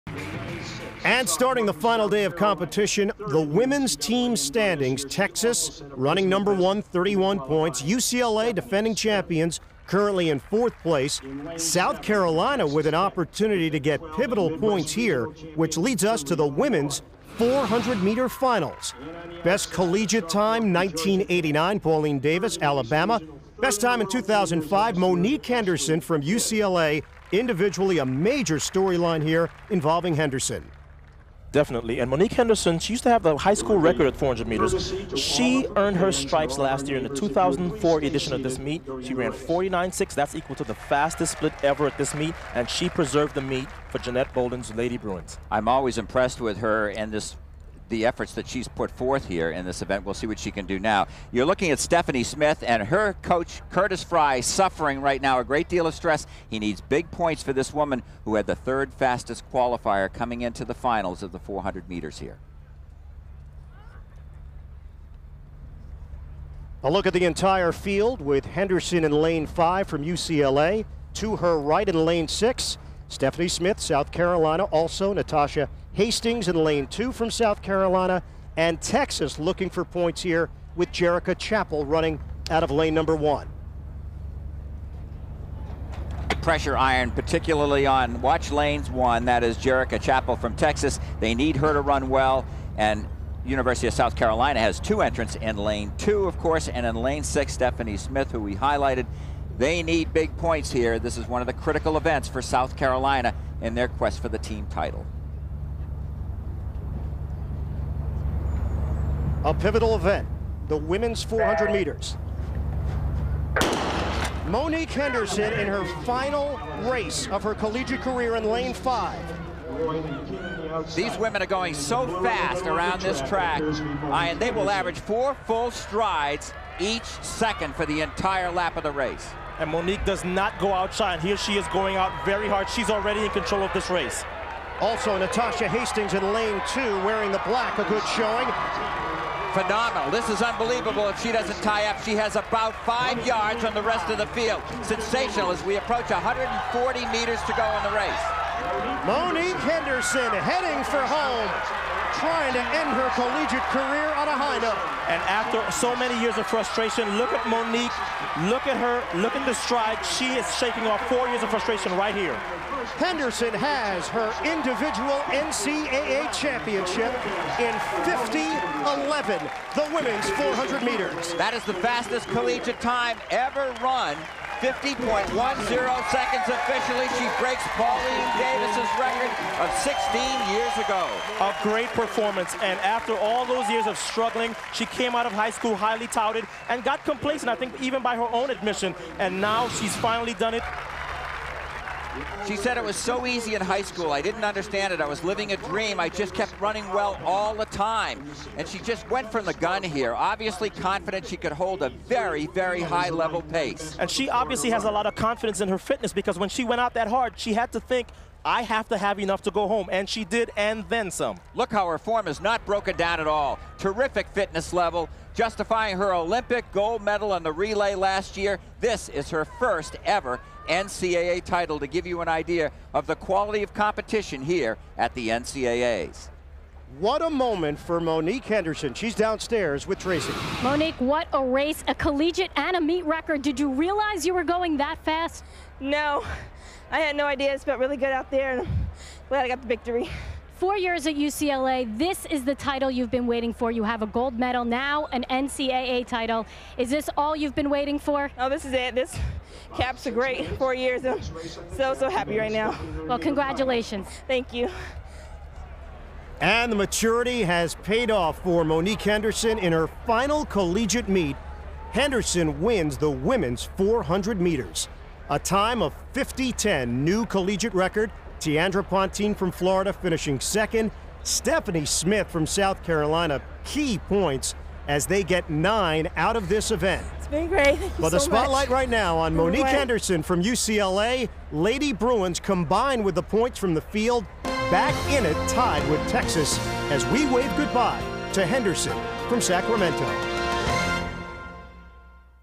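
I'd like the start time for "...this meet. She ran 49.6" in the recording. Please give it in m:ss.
0:38.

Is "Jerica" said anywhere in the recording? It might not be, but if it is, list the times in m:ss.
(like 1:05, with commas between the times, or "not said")
1:20, 1:29.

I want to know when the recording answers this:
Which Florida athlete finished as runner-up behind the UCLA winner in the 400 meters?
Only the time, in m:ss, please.
4:28.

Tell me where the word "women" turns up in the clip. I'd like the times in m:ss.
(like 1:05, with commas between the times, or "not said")
0:03, 0:16, 1:50, 2:01, 2:49, 4:23.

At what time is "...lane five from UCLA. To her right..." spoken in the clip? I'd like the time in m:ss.
1:09.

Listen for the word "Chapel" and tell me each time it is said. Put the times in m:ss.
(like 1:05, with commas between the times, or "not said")
1:21, 1:30.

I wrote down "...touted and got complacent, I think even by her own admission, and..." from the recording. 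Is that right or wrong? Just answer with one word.
right.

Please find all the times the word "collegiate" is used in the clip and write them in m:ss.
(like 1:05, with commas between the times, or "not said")
0:19, 1:57, 2:33, 2:52, 3:51, 4:20, 4:27.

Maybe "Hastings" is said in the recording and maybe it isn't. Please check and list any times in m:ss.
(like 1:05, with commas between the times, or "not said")
1:15, 2:15.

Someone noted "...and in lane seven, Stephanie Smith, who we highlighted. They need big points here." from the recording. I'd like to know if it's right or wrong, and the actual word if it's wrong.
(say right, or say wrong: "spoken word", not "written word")
wrong: "six", not "seven".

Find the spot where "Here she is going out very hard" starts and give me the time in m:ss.
2:11.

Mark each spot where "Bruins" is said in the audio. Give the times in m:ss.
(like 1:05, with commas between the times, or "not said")
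0:44, 4:41.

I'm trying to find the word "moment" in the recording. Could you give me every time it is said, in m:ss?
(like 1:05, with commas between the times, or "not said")
3:47.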